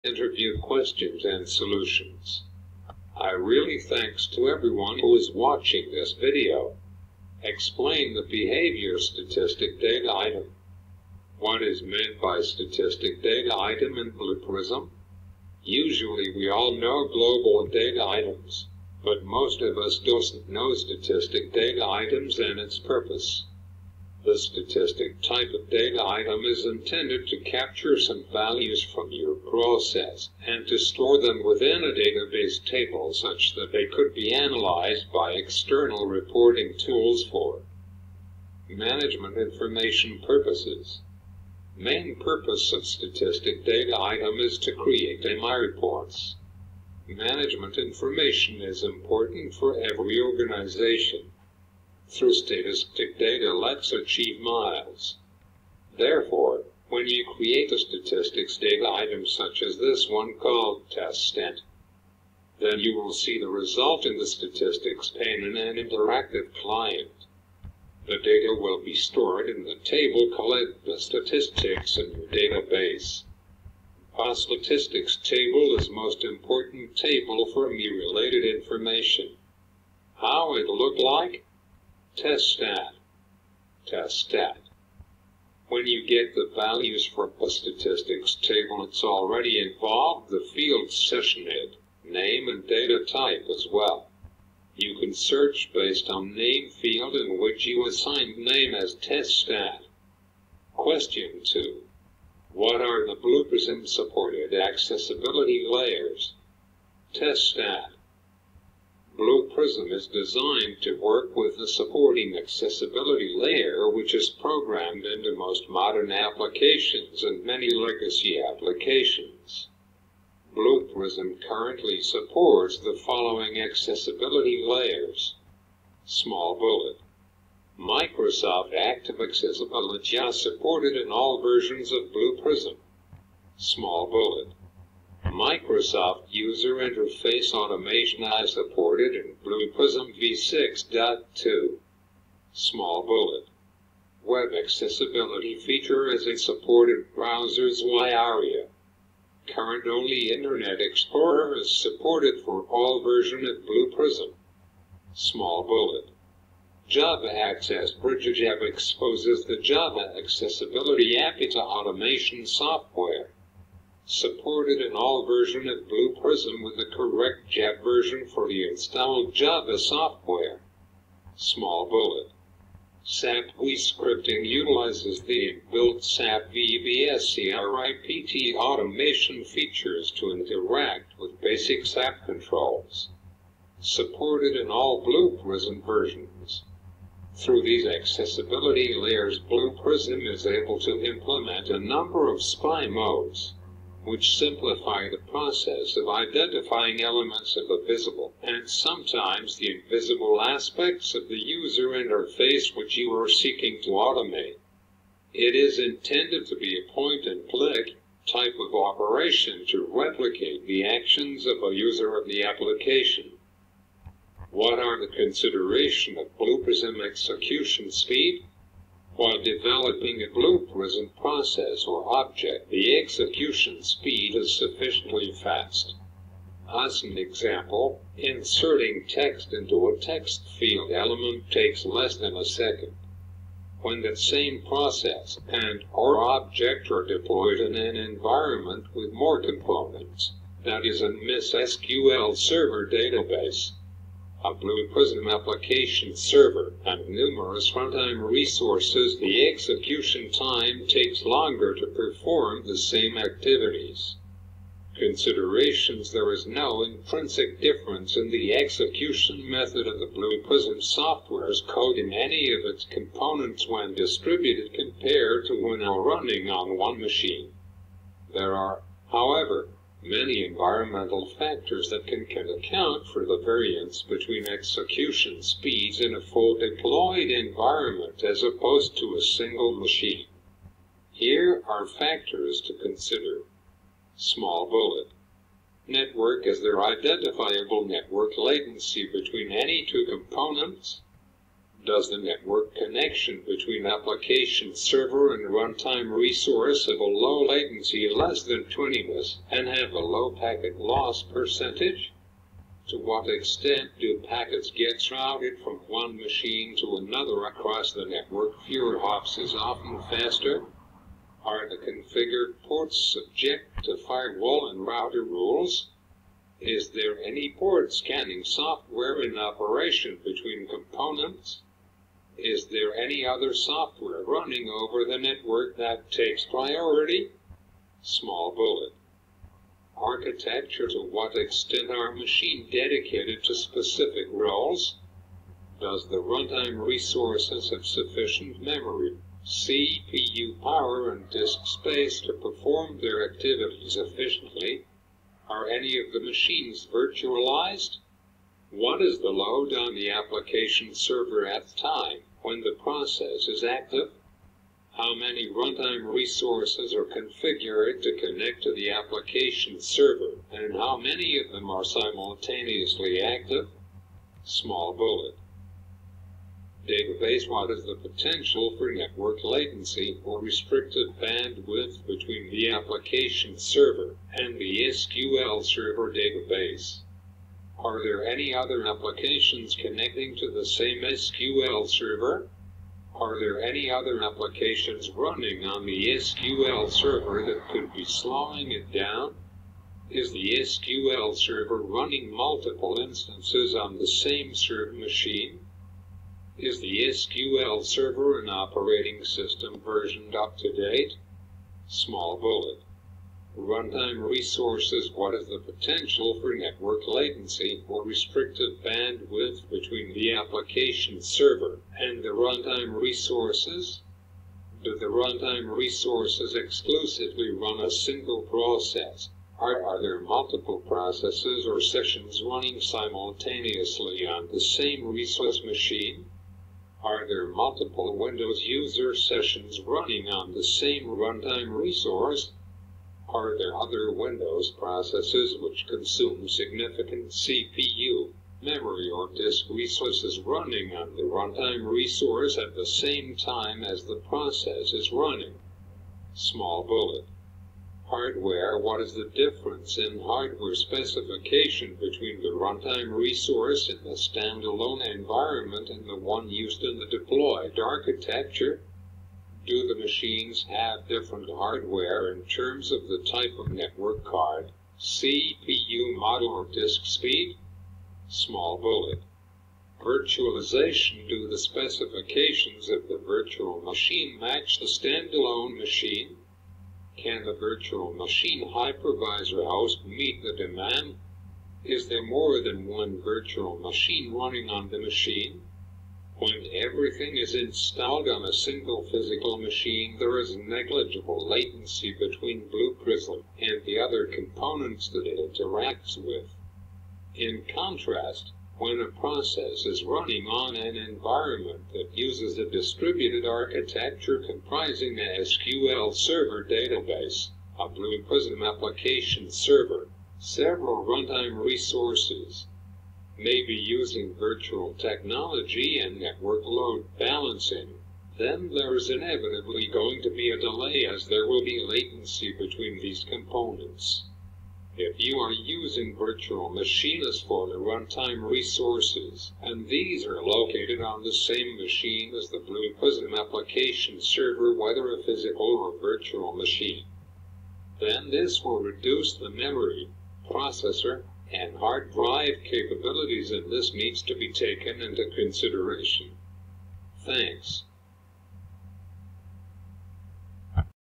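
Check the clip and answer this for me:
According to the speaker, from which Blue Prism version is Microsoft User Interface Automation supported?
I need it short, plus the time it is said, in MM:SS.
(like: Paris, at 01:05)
v6.2, at 02:20.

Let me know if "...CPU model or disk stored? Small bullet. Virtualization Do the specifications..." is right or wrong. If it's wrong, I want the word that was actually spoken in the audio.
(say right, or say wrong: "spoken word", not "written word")
wrong: "speed", not "stored".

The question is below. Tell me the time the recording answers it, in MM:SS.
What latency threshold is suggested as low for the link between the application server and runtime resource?
04:58.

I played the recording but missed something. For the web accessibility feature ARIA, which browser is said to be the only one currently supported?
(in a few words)
Internet Explorer.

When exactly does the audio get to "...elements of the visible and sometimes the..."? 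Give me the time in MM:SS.
03:17.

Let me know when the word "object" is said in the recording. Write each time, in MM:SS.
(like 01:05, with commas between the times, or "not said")
03:42, 03:56.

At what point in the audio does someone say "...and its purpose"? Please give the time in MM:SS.
00:22.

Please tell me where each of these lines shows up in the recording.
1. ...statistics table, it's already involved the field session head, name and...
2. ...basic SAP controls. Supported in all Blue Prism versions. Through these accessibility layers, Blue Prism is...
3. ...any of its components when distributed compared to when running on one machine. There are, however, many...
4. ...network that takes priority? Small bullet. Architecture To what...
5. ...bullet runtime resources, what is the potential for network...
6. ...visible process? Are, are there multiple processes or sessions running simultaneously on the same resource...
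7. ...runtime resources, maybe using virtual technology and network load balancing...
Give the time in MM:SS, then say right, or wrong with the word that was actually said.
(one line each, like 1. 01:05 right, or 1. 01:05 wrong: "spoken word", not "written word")
1. 01:27 right
2. 03:01 right
3. 04:22 right
4. 05:25 right
5. 06:42 right
6. 06:57 wrong: "single", not "visible"
7. 08:31 right.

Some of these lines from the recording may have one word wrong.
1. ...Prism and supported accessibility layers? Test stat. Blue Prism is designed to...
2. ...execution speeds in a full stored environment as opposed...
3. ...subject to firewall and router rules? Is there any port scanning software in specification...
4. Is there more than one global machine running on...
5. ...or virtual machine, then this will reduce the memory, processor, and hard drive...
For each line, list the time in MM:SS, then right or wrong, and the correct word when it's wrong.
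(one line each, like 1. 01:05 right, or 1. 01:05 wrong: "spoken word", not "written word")
1. 01:43 right
2. 04:34 wrong: "deployed", not "stored"
3. 05:13 wrong: "operation", not "specification"
4. 08:01 wrong: "virtual", not "global"
5. 08:55 right.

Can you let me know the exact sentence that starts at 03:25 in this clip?
It is intended to be a point-and-click type of operation to replicate the actions of a user of the application.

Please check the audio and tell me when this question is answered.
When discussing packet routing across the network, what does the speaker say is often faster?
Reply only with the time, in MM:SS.
05:08.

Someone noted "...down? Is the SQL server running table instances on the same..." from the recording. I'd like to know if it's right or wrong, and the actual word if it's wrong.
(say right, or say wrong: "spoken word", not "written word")
wrong: "multiple", not "table".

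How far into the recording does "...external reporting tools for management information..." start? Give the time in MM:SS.
00:35.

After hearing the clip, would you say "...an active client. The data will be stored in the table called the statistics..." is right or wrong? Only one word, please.
wrong.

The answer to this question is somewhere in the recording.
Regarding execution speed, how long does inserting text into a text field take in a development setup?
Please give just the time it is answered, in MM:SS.
03:51.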